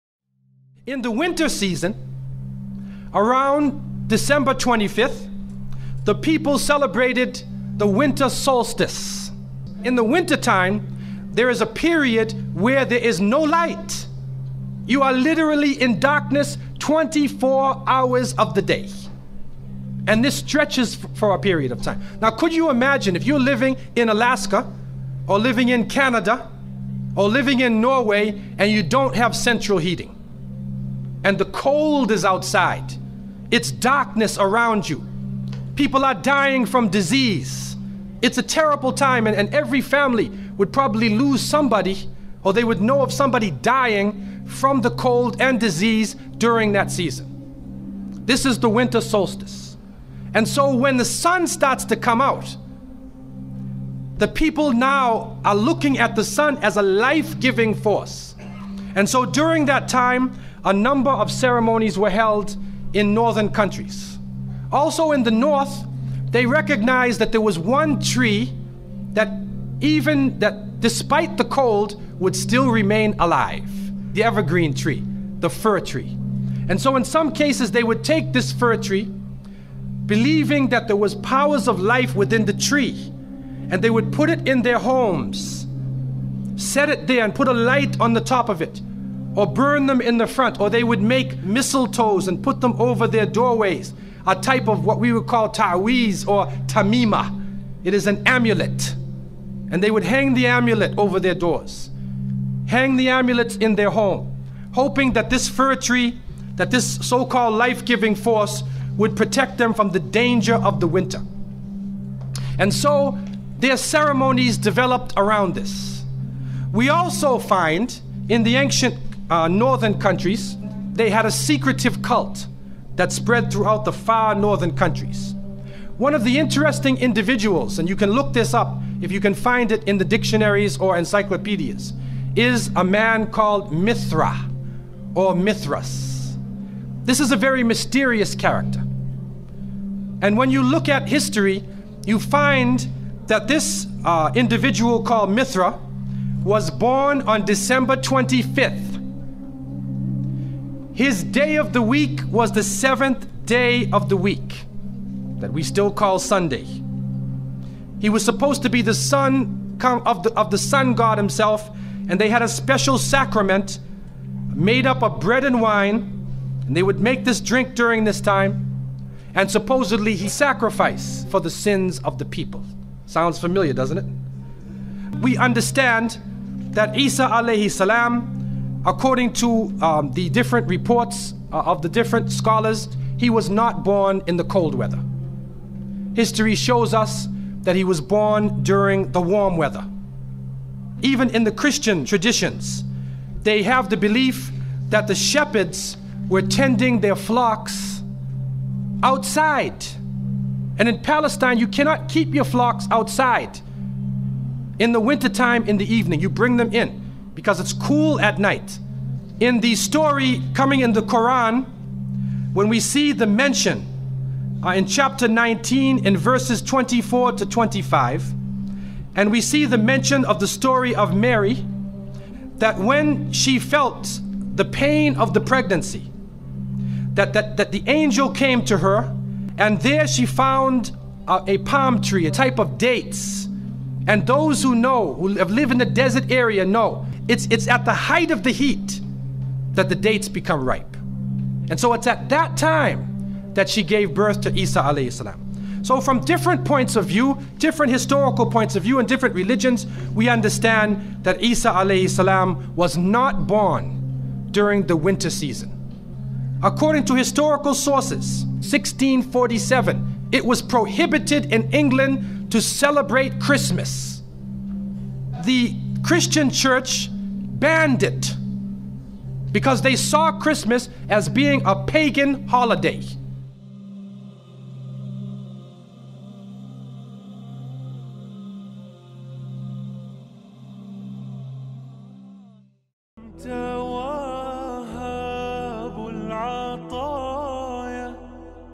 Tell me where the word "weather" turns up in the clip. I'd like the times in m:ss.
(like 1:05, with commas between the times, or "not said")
3:04, 3:09.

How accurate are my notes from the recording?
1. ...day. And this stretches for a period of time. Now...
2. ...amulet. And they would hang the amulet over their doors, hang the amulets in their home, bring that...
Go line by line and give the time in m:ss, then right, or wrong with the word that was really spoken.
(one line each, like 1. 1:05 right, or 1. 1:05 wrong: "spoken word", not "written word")
1. 0:18 right
2. 1:38 wrong: "hoping", not "bring".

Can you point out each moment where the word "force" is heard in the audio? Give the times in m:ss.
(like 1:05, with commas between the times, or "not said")
0:57, 1:48.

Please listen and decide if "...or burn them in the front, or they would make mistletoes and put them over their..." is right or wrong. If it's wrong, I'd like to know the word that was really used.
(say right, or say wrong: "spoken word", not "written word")
right.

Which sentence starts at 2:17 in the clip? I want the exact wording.
This is a very mysterious character.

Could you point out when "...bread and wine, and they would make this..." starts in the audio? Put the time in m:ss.
2:45.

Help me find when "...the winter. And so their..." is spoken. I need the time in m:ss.
1:50.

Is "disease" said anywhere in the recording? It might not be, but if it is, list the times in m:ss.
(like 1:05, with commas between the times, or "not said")
0:36, 0:45.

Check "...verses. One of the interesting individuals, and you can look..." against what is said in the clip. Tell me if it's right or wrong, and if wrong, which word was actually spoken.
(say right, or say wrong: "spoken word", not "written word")
wrong: "countries", not "verses".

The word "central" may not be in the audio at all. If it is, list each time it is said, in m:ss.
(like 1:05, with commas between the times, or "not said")
0:29.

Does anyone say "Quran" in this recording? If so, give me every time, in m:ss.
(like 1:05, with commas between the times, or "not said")
3:31.